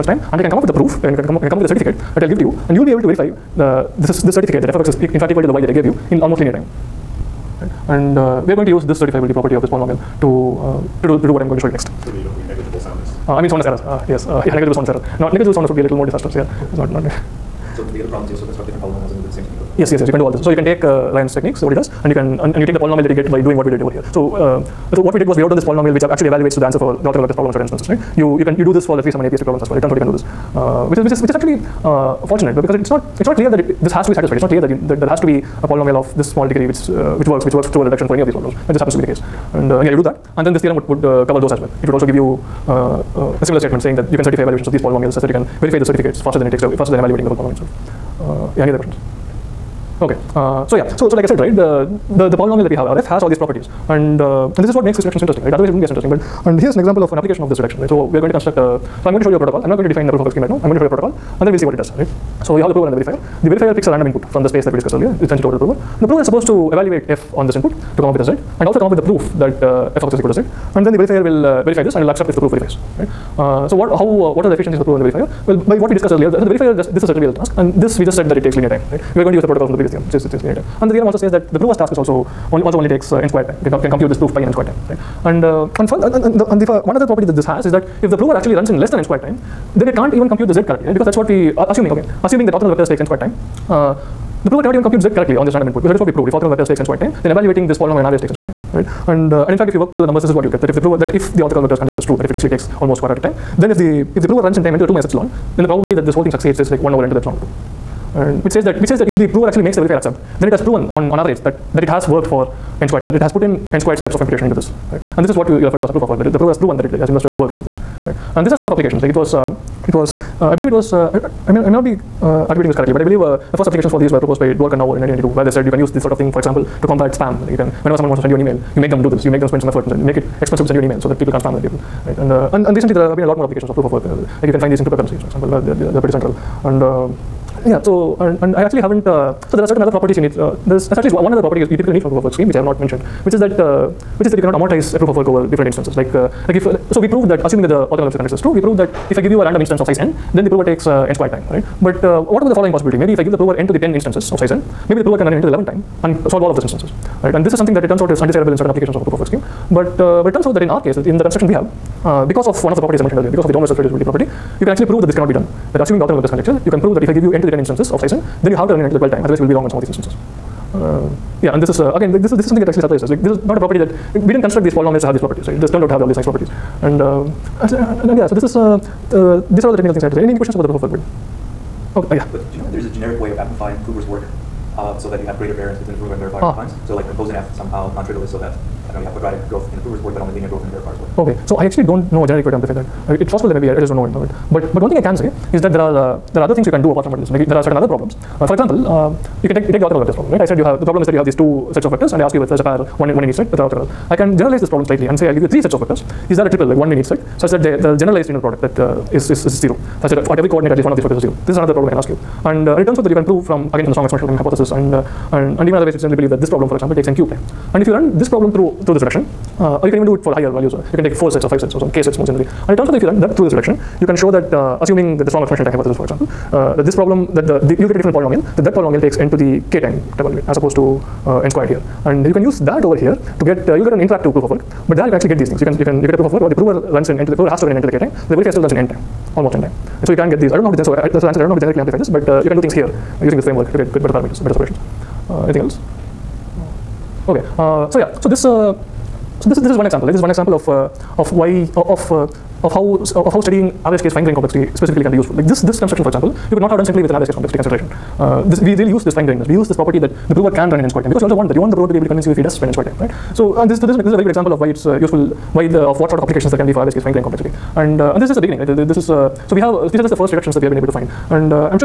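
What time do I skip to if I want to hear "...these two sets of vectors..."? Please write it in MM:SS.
03:21.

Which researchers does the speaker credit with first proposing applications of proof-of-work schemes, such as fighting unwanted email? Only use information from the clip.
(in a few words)
Dwork and Naor.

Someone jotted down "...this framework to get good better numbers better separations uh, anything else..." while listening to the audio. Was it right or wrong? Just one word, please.
wrong.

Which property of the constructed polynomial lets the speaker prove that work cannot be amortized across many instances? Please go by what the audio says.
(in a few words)
Downward self-reducibility.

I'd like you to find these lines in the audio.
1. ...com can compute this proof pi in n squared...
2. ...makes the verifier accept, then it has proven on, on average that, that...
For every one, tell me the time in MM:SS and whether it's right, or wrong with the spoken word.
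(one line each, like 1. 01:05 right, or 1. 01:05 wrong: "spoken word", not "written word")
1. 01:23 right
2. 01:49 right.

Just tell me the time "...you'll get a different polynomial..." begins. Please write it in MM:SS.
03:47.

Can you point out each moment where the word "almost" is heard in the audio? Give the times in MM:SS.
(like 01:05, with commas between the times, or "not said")
00:06, 01:42, 03:59.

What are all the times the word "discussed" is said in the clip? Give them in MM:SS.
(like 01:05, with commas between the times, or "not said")
01:04, 01:15.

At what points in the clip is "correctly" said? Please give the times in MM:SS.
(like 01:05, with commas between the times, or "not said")
01:30, 01:35, 02:02.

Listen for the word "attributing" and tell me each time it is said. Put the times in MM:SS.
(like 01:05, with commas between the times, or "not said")
02:02.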